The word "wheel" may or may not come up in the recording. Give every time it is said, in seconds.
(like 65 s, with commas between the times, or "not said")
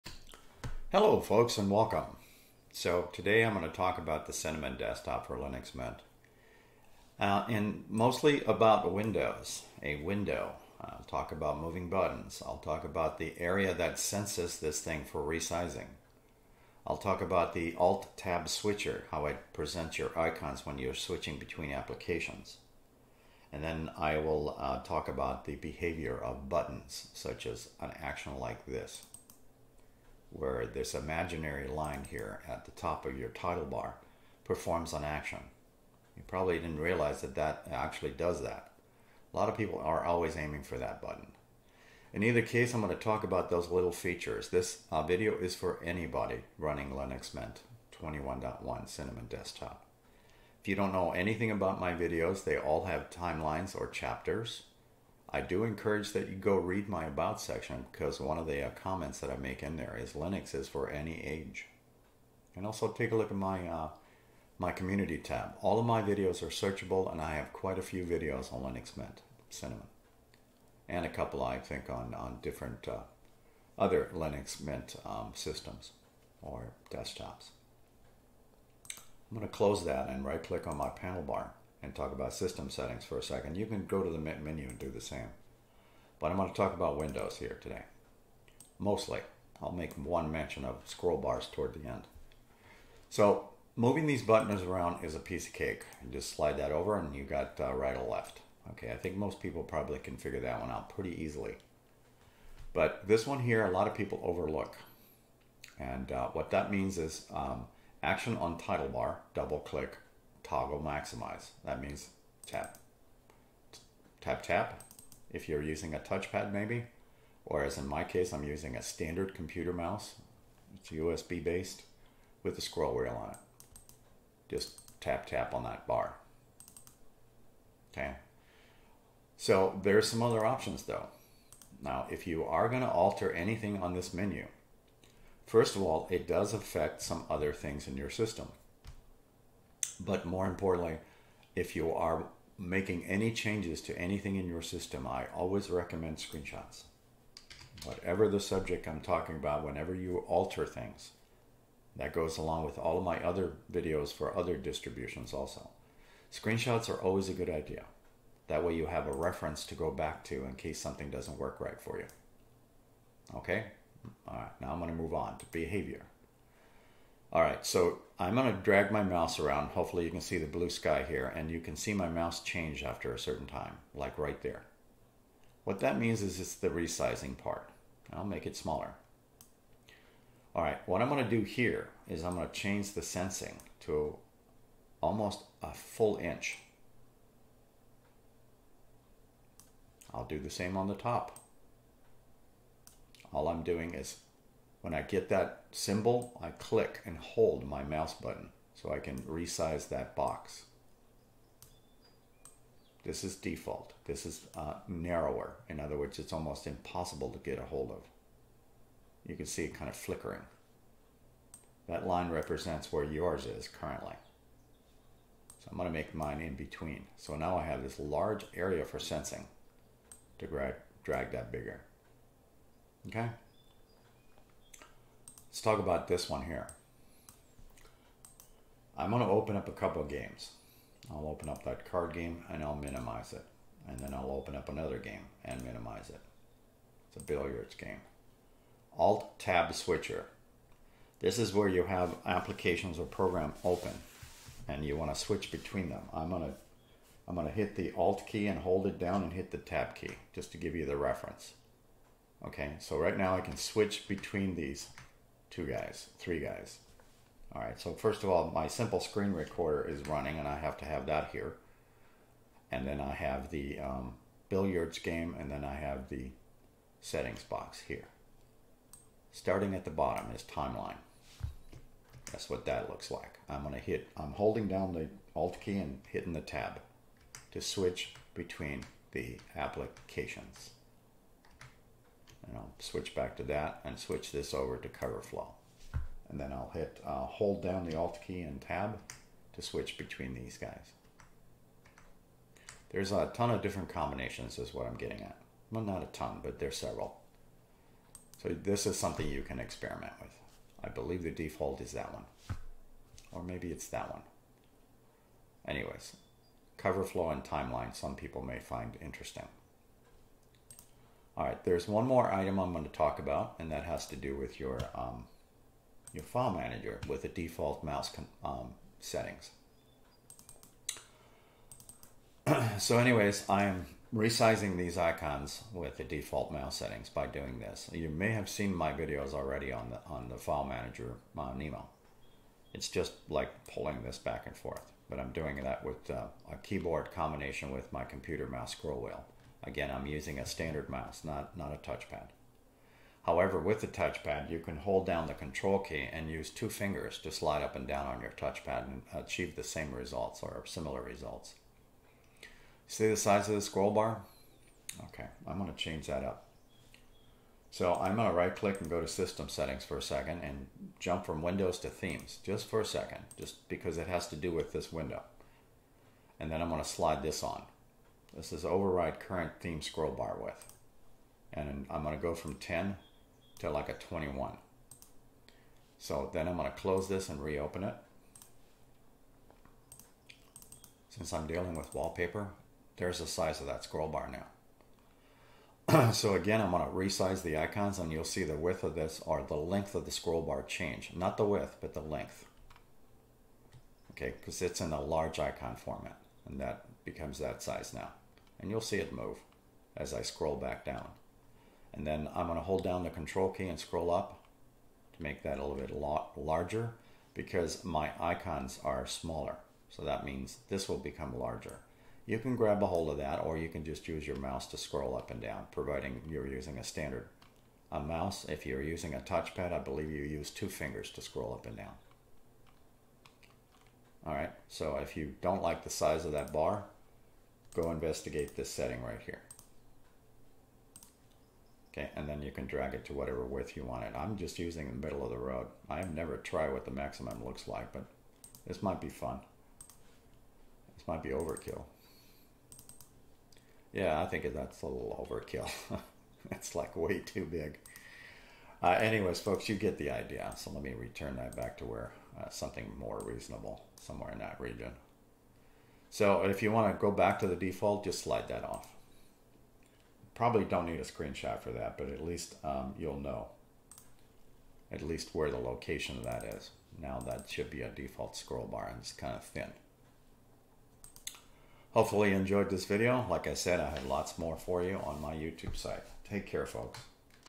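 122 s, 339 s.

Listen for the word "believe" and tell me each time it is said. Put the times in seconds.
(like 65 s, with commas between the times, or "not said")
300 s, 419 s.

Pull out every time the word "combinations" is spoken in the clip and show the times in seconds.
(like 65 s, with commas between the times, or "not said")
293 s, 337 s.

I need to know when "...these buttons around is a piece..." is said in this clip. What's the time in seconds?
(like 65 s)
94 s.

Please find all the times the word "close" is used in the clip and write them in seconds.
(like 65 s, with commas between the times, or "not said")
79 s, 376 s.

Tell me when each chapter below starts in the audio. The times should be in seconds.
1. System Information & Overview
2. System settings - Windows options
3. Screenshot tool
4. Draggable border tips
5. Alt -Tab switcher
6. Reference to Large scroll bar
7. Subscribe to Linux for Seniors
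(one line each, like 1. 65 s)
1. 15 s
2. 86 s
3. 133 s
4. 167 s
5. 229 s
6. 335 s
7. 470 s.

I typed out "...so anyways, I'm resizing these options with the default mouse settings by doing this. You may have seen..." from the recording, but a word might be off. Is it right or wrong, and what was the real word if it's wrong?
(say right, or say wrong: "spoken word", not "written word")
wrong: "icons", not "options".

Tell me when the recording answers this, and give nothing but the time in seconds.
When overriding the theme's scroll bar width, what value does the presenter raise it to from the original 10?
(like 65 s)
373 s.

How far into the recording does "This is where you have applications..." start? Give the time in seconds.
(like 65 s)
241 s.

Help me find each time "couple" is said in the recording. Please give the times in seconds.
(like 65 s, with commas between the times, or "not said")
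71 s, 229 s.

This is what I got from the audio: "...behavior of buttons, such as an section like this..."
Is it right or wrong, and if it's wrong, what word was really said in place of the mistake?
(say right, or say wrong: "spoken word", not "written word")
wrong: "action", not "section".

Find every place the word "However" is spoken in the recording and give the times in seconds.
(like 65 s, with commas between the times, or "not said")
343 s.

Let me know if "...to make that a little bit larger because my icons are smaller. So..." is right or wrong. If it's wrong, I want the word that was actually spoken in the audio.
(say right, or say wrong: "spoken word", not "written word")
right.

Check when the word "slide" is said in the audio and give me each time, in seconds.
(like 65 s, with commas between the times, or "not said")
96 s, 347 s, 366 s, 458 s.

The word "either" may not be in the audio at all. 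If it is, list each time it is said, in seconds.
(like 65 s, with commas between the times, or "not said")
42 s.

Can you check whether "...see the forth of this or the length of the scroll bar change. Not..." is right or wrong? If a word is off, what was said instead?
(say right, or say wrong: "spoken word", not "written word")
wrong: "width", not "forth".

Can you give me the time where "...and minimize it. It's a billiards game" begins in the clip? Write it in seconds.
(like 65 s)
235 s.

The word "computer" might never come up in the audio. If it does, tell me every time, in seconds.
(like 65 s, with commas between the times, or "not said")
119 s, 338 s.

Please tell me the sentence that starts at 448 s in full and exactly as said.
Uh, anyways, folks, you get the idea.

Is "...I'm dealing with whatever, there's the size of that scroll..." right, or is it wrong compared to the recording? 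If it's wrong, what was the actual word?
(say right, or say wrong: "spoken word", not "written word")
wrong: "wallpaper", not "whatever".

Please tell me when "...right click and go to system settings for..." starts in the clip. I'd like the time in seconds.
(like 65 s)
358 s.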